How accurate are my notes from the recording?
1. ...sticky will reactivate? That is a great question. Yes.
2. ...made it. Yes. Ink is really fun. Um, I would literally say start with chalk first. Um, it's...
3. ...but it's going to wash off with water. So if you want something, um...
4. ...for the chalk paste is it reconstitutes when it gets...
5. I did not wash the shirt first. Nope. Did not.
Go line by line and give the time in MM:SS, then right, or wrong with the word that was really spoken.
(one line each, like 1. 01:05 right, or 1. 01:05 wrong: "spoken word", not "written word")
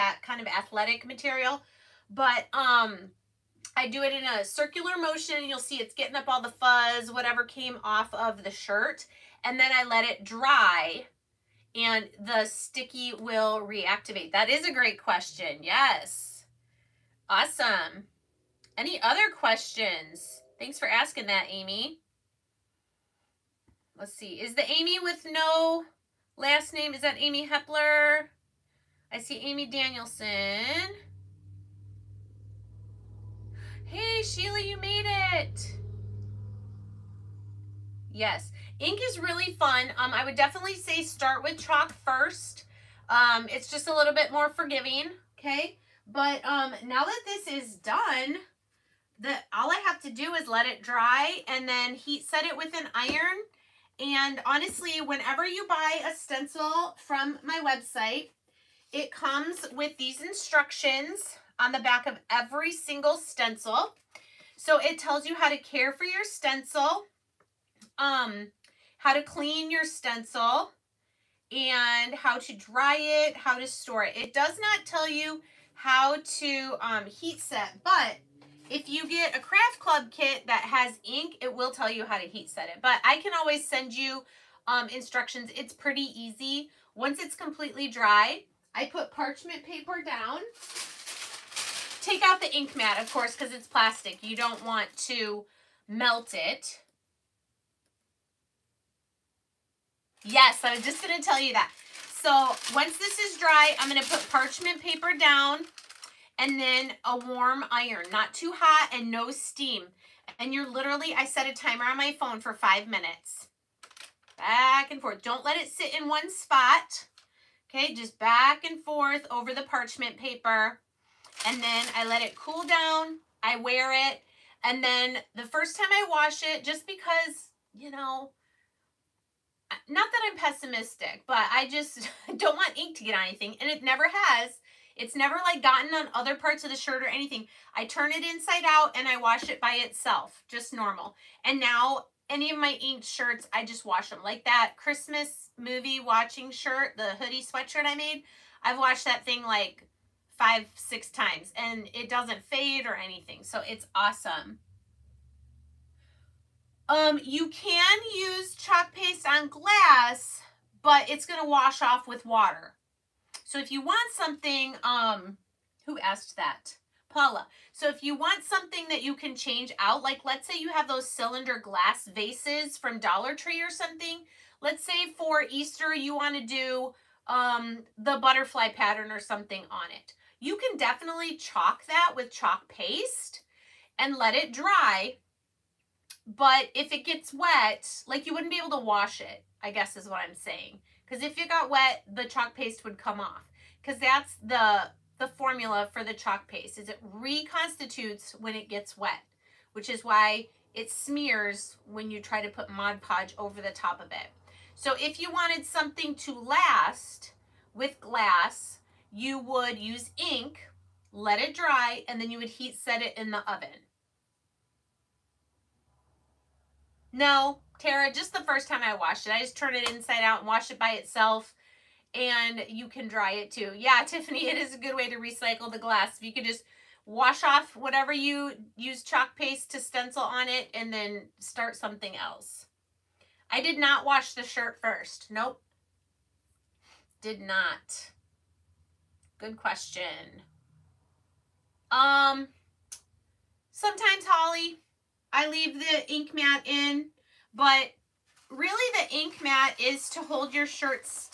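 1. 00:12 right
2. 00:34 wrong: "definitely", not "literally"
3. 02:40 right
4. 03:15 right
5. 03:53 right.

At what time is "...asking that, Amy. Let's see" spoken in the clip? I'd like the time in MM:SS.
00:20.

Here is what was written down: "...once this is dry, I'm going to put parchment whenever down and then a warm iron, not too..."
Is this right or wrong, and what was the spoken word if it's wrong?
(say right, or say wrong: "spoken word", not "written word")
wrong: "paper", not "whenever".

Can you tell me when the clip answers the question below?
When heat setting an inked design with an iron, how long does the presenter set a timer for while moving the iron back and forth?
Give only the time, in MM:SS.
01:52.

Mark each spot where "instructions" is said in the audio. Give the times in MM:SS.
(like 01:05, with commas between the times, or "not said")
01:00, 01:24.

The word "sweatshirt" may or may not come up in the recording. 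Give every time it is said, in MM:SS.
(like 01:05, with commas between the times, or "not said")
02:27.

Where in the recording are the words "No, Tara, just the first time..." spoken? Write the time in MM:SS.
03:37.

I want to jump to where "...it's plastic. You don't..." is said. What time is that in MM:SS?
01:33.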